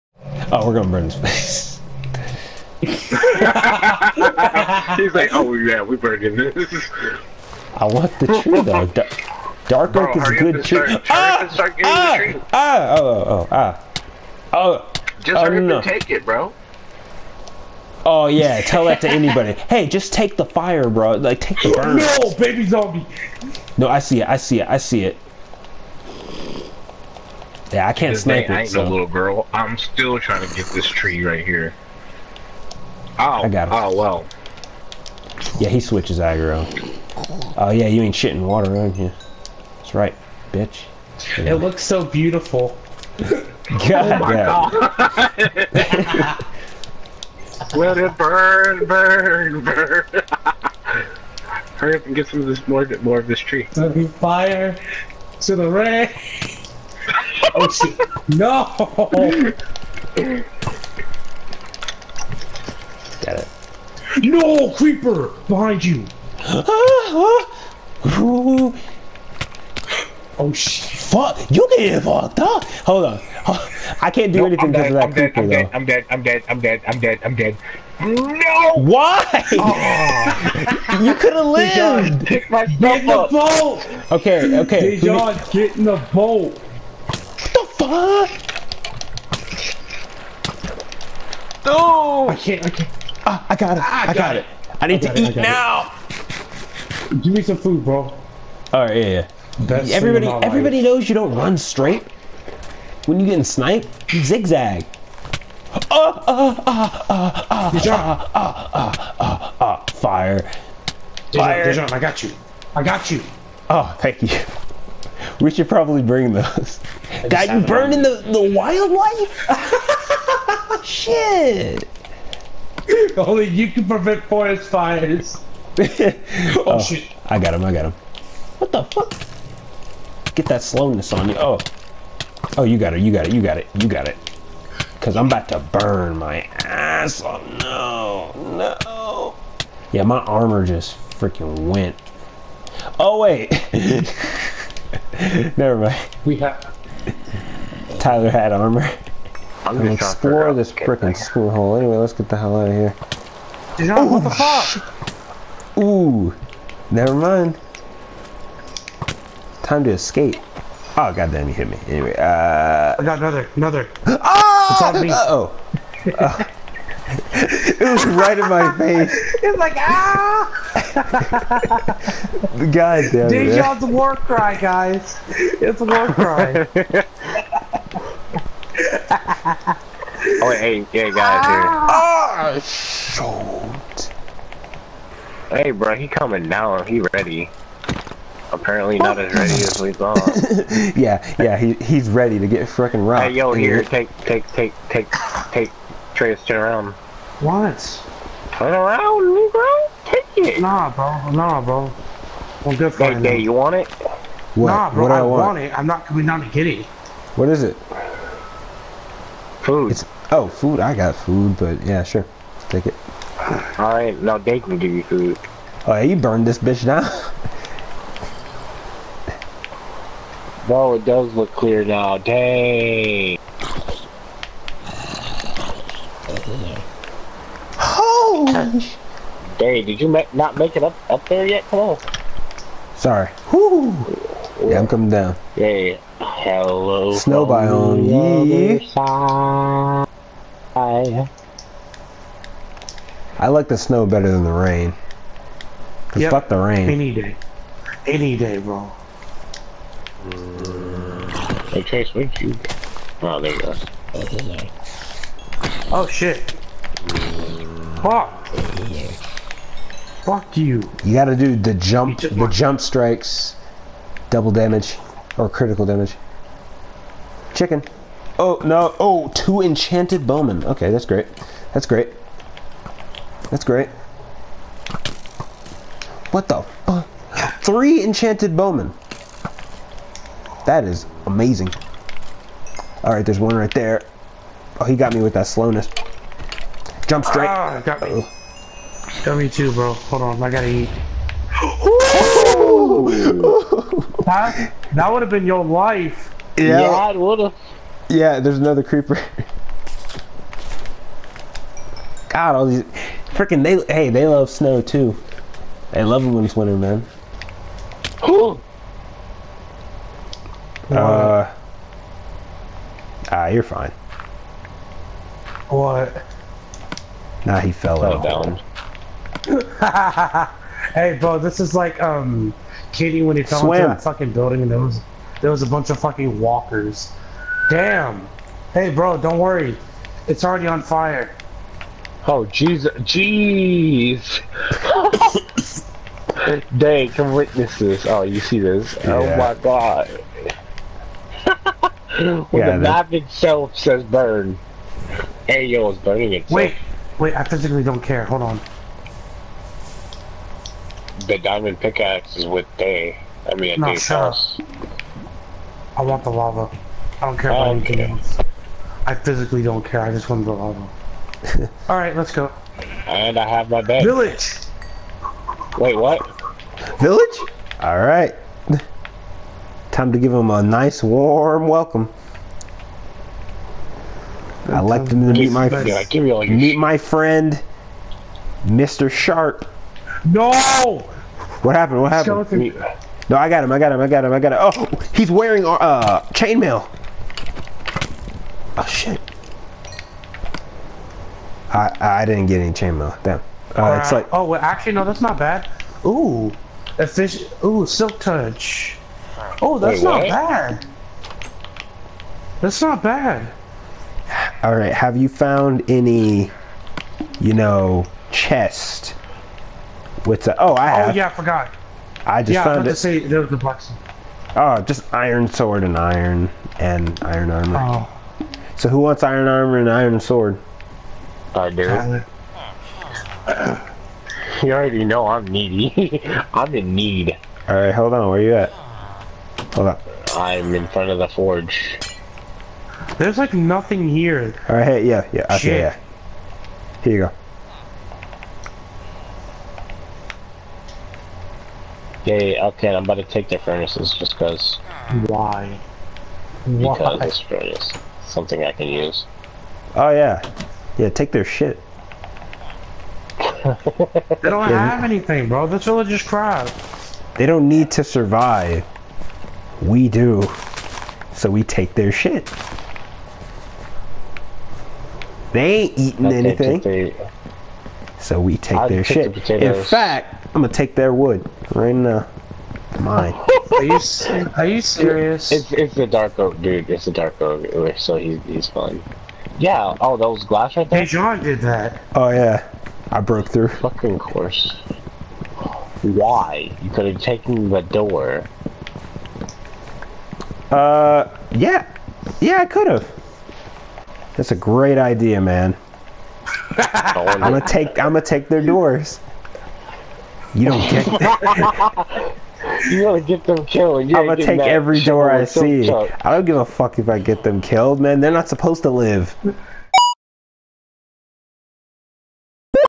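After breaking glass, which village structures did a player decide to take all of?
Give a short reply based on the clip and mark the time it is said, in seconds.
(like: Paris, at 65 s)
Doors, at 498 s.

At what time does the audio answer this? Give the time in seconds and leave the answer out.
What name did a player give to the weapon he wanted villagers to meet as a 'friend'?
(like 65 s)
378 s.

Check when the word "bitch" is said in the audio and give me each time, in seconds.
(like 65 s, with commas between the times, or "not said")
40 s, 216 s.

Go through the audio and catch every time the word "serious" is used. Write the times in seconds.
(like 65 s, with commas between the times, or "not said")
474 s.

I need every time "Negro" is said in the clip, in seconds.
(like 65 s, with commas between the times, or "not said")
199 s.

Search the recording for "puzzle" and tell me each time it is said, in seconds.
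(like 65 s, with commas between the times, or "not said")
not said.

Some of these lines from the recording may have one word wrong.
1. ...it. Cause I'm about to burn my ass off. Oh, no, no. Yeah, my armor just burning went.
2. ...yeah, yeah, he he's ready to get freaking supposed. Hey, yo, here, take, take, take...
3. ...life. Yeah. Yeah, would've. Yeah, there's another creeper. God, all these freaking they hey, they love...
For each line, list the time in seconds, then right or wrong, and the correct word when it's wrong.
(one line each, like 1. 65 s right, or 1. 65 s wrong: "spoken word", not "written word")
1. 134 s wrong: "freaking", not "burning"
2. 190 s wrong: "rocked", not "supposed"
3. 295 s right.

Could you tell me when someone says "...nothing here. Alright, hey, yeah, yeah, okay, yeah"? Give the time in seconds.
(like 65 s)
433 s.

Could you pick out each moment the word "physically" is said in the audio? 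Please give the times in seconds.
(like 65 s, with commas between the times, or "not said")
347 s, 359 s.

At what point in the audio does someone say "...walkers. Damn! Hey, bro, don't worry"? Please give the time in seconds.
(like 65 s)
326 s.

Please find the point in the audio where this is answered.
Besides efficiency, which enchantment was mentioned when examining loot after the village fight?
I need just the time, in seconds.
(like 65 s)
397 s.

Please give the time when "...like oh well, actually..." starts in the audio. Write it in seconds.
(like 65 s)
394 s.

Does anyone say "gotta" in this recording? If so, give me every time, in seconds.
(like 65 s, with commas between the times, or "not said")
261 s, 290 s, 503 s.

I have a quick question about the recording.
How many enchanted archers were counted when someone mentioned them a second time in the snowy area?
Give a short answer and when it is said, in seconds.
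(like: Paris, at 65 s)
3, at 277 s.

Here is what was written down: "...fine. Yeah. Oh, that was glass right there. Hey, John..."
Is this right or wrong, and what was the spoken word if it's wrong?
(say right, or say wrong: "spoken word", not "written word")
right.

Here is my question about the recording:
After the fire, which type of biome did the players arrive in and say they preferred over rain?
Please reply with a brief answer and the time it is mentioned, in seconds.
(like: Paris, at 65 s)
Snow biome, at 237 s.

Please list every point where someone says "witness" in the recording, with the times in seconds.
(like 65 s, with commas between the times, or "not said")
337 s.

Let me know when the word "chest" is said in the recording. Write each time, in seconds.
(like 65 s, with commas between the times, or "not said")
408 s.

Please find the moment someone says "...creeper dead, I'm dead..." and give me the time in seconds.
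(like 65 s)
75 s.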